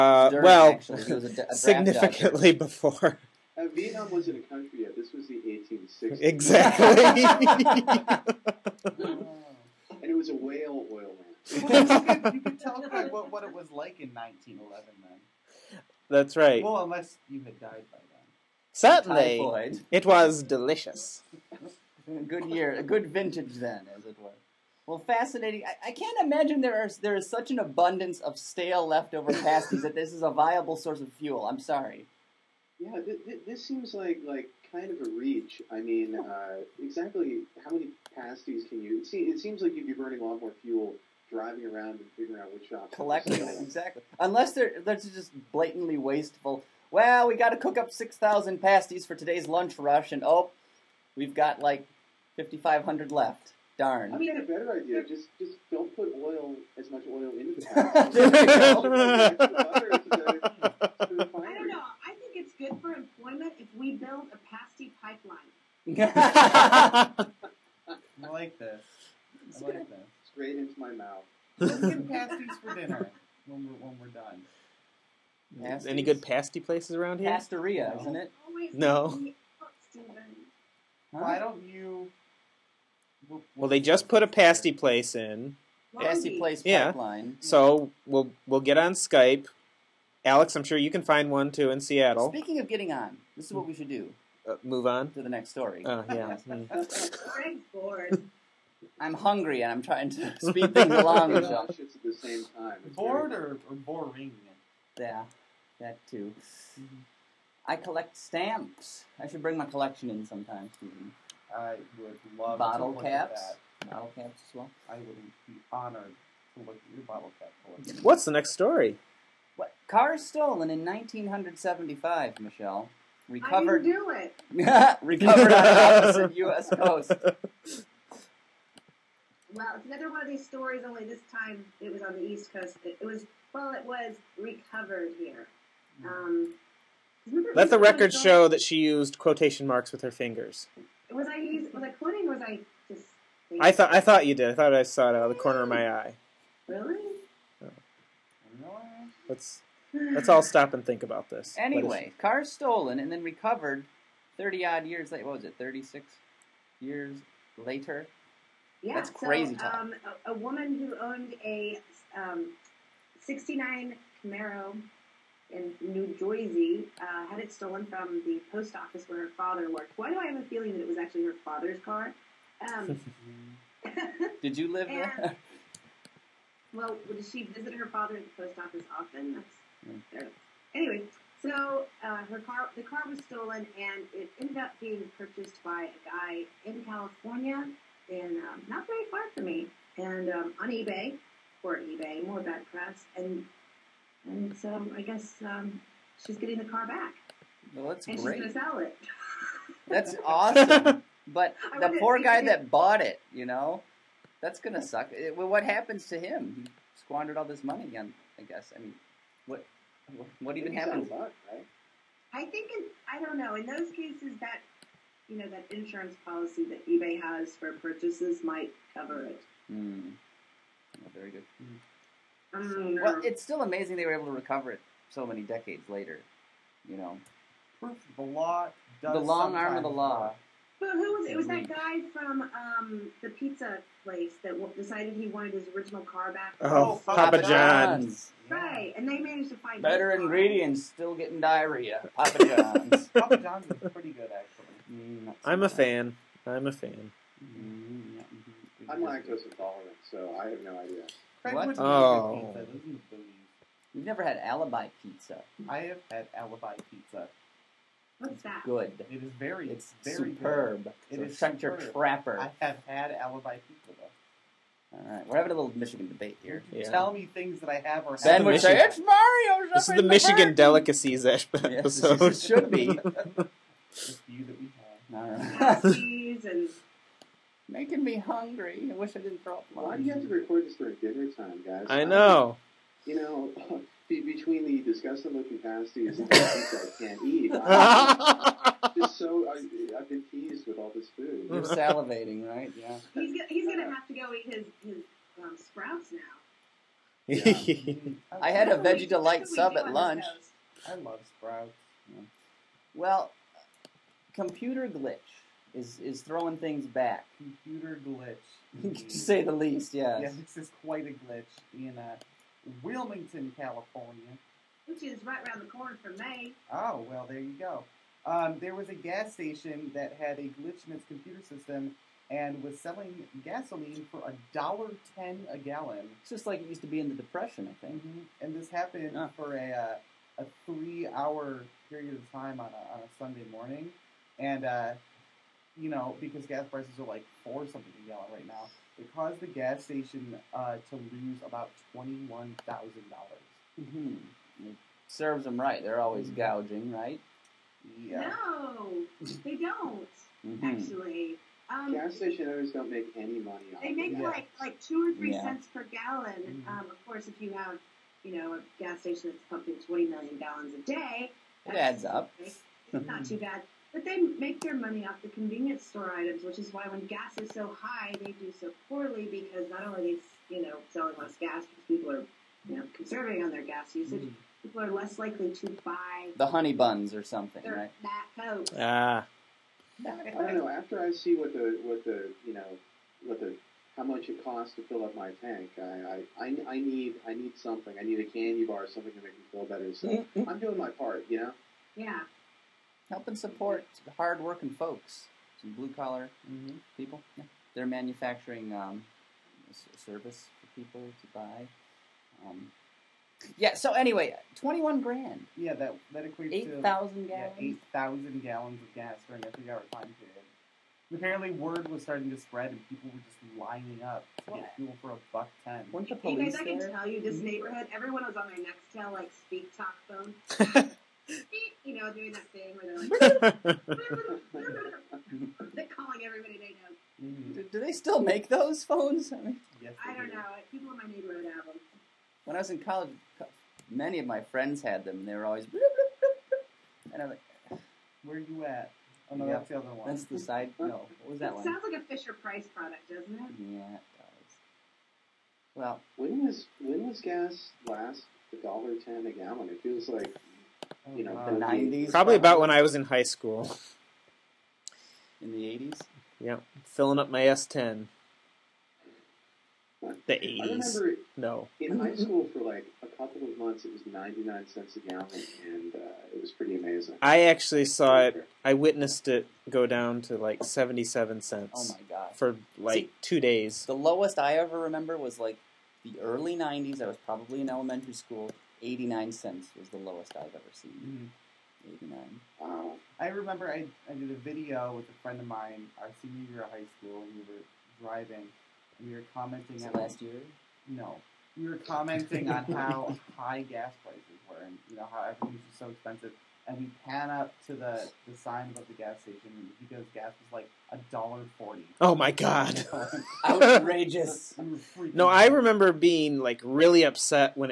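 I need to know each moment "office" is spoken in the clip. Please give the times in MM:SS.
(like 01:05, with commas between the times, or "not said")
02:48, 02:58.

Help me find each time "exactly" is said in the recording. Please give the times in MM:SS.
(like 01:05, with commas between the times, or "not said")
00:06, 00:36, 00:43.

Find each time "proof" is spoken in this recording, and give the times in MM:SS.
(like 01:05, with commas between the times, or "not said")
03:47.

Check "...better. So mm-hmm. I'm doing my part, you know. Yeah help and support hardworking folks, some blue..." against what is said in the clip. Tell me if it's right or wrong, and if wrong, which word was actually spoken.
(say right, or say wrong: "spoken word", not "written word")
right.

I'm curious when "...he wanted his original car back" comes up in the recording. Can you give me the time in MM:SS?
03:55.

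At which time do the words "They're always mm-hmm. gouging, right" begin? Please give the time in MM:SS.
05:45.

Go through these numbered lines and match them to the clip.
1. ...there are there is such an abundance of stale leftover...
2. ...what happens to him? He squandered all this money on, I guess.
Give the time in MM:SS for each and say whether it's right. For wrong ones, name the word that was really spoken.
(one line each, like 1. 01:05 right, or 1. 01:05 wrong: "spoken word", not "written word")
1. 00:26 right
2. 03:25 right.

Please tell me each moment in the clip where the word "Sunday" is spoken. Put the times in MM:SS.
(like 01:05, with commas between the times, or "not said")
05:33.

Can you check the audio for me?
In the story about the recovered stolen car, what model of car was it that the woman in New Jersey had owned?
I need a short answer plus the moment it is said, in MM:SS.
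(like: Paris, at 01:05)
69 Camaro, at 02:43.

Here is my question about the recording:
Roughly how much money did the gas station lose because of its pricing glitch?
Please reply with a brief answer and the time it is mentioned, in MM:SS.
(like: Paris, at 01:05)
$21,000, at 05:41.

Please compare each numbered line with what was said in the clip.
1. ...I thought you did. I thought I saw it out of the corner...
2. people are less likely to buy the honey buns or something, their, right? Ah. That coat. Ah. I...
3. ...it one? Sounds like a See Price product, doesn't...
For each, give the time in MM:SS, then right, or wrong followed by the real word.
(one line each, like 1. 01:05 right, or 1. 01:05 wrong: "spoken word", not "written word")
1. 02:23 right
2. 06:14 right
3. 07:21 wrong: "Fisher", not "See".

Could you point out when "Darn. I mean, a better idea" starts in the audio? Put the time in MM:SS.
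00:53.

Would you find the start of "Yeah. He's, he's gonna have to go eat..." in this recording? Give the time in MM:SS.
04:52.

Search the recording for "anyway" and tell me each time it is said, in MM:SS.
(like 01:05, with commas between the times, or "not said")
02:31, 03:00, 06:43.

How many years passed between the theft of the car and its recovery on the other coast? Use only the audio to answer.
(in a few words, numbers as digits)
36.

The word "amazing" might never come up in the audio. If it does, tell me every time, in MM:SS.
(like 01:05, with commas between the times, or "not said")
03:43, 07:46.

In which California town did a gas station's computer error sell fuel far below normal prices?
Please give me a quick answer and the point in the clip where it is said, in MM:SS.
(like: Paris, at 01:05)
Wilmington, at 05:12.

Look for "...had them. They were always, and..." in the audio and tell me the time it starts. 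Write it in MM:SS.
07:14.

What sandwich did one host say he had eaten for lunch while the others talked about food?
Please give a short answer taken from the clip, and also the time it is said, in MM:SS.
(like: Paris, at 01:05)
veggie delight sub, at 04:58.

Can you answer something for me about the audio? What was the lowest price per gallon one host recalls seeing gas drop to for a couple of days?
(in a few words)
77 cents.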